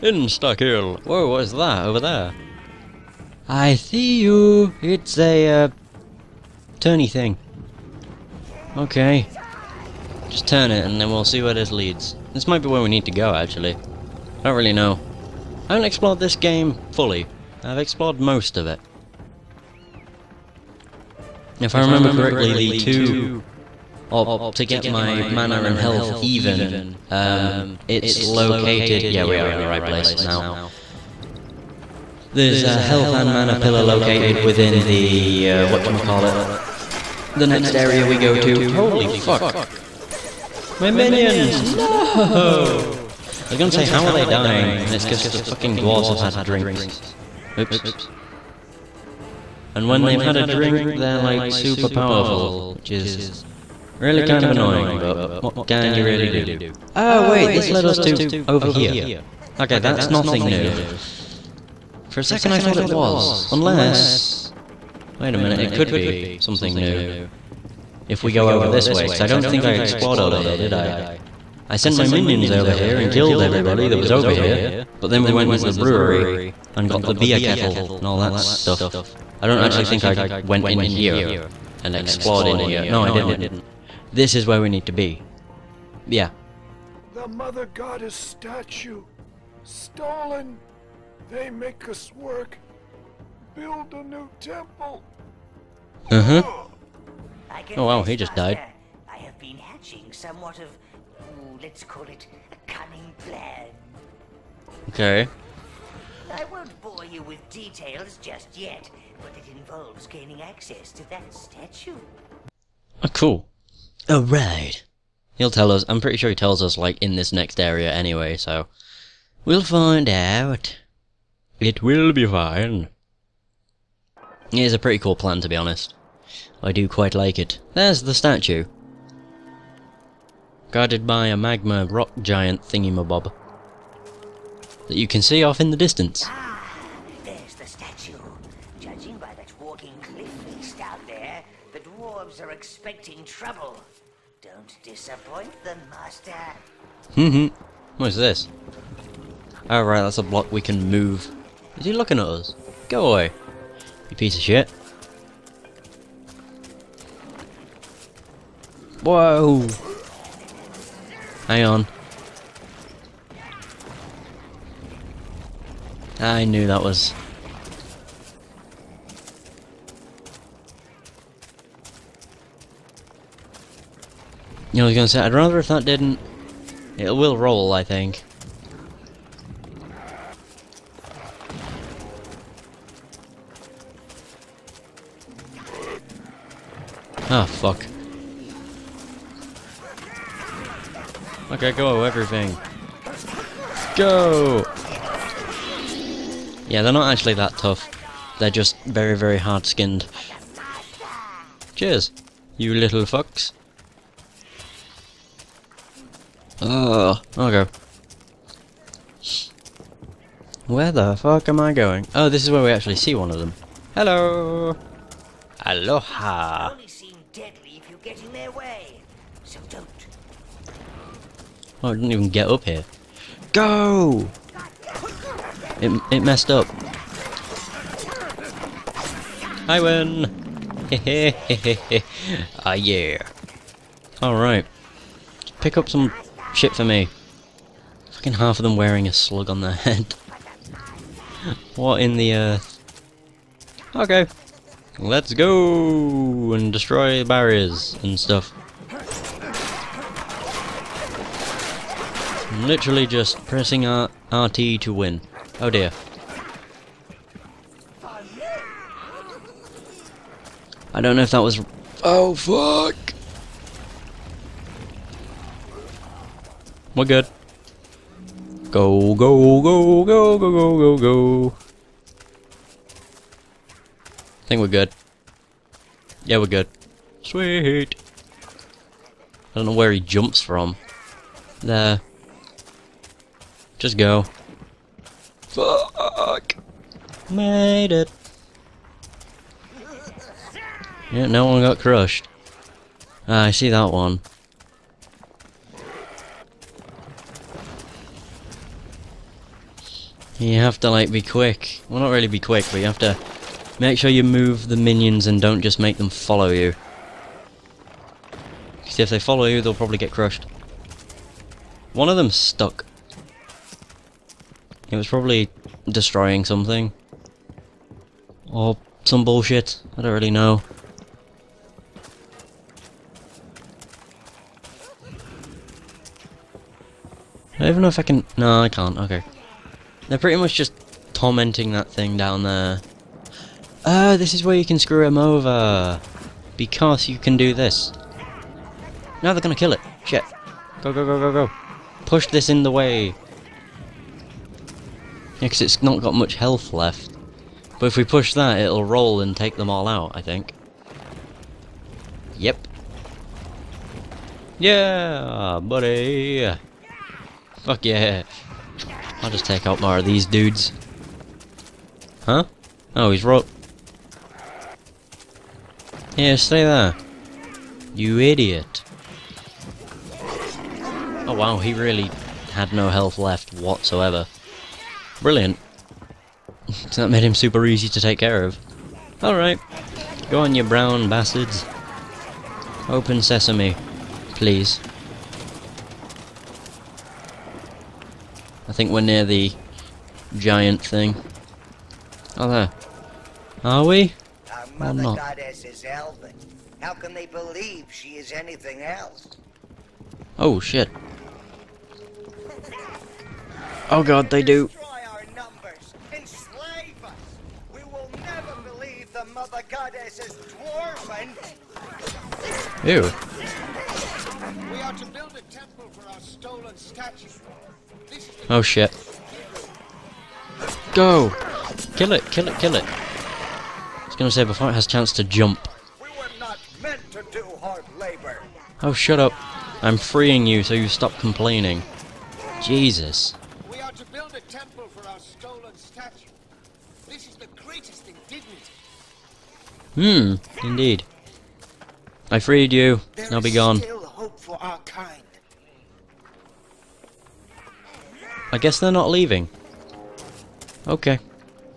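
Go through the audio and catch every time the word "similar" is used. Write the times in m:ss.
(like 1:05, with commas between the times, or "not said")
not said.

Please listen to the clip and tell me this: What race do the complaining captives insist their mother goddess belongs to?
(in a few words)
Elven.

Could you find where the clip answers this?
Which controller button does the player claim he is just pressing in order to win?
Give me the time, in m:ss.
4:13.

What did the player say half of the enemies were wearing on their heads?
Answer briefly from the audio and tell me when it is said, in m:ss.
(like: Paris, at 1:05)
A slug, at 3:58.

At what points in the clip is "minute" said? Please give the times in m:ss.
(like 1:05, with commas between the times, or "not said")
1:05.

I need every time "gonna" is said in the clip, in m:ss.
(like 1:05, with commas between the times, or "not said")
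0:43, 2:54, 5:39, 7:04.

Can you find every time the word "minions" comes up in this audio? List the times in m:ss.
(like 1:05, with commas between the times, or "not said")
0:40, 1:12, 5:04.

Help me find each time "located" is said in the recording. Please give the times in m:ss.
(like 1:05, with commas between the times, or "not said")
0:28, 0:33.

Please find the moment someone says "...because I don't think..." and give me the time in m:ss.
1:09.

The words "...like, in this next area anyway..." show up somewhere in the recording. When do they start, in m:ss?
1:56.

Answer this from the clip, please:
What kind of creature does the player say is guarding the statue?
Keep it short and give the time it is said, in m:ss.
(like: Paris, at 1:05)
A magma rock giant, at 2:11.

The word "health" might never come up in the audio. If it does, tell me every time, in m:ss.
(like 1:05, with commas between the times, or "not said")
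0:25, 0:32, 5:46, 6:12.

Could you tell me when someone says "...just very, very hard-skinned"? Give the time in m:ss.
3:18.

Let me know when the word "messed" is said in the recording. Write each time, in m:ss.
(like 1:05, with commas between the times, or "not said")
3:46.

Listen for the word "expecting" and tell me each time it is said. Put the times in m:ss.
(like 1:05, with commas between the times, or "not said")
2:22.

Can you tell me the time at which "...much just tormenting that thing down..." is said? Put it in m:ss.
5:30.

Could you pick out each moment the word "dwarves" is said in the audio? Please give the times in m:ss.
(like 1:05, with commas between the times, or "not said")
0:45, 2:21.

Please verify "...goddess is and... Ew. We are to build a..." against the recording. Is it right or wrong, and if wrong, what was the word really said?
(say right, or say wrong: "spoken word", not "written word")
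right.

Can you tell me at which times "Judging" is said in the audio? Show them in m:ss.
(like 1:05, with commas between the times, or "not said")
2:18.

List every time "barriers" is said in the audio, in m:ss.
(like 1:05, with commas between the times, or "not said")
4:07.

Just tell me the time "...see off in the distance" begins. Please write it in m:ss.
2:15.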